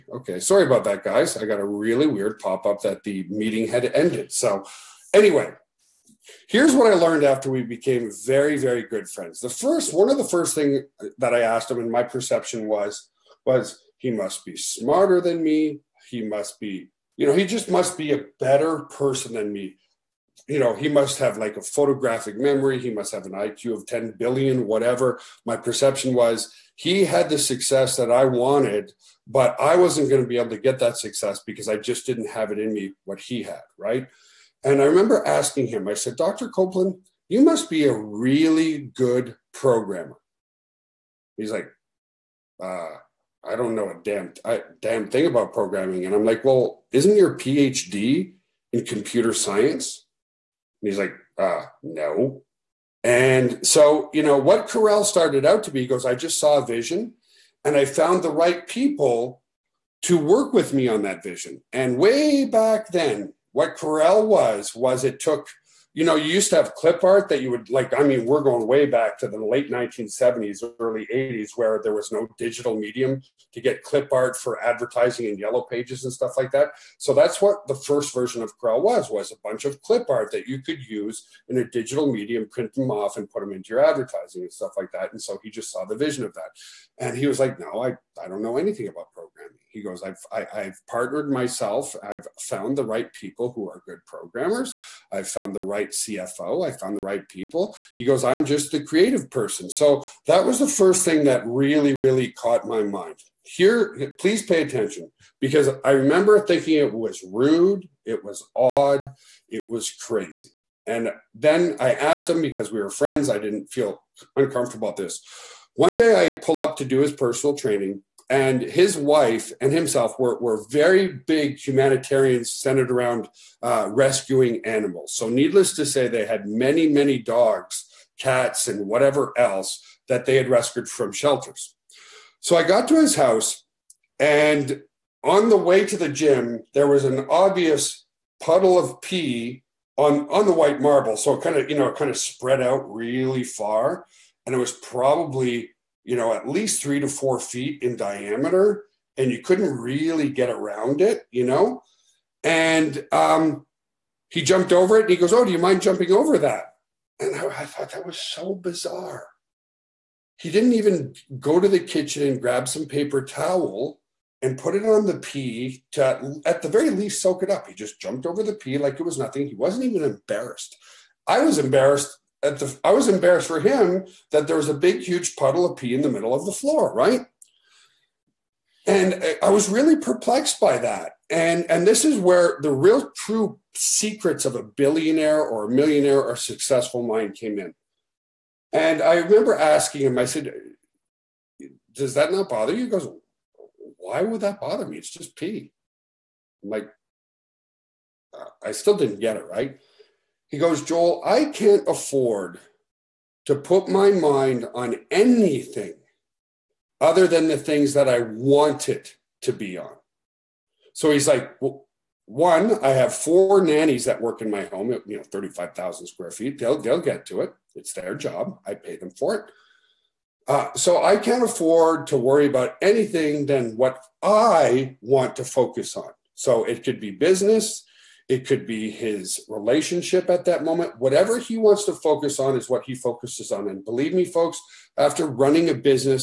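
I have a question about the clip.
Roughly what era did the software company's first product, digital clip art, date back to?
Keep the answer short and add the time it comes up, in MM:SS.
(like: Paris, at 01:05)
late 1970s, at 01:09.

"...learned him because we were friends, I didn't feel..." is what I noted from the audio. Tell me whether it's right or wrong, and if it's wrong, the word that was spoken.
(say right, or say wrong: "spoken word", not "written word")
wrong: "asked", not "learned".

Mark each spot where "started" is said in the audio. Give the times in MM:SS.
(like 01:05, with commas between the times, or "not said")
00:55.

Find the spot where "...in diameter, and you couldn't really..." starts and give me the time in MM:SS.
02:27.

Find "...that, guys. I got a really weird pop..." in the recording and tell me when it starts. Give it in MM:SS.
00:00.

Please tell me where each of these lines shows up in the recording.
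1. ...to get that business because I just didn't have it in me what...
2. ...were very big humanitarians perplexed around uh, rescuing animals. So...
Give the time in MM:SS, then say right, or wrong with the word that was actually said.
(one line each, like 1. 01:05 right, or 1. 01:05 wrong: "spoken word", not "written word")
1. 00:30 wrong: "success", not "business"
2. 02:00 wrong: "centered", not "perplexed".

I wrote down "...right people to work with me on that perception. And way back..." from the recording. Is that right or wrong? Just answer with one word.
wrong.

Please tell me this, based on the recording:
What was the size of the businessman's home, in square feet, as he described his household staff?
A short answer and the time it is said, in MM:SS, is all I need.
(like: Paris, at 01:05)
35,000, at 03:35.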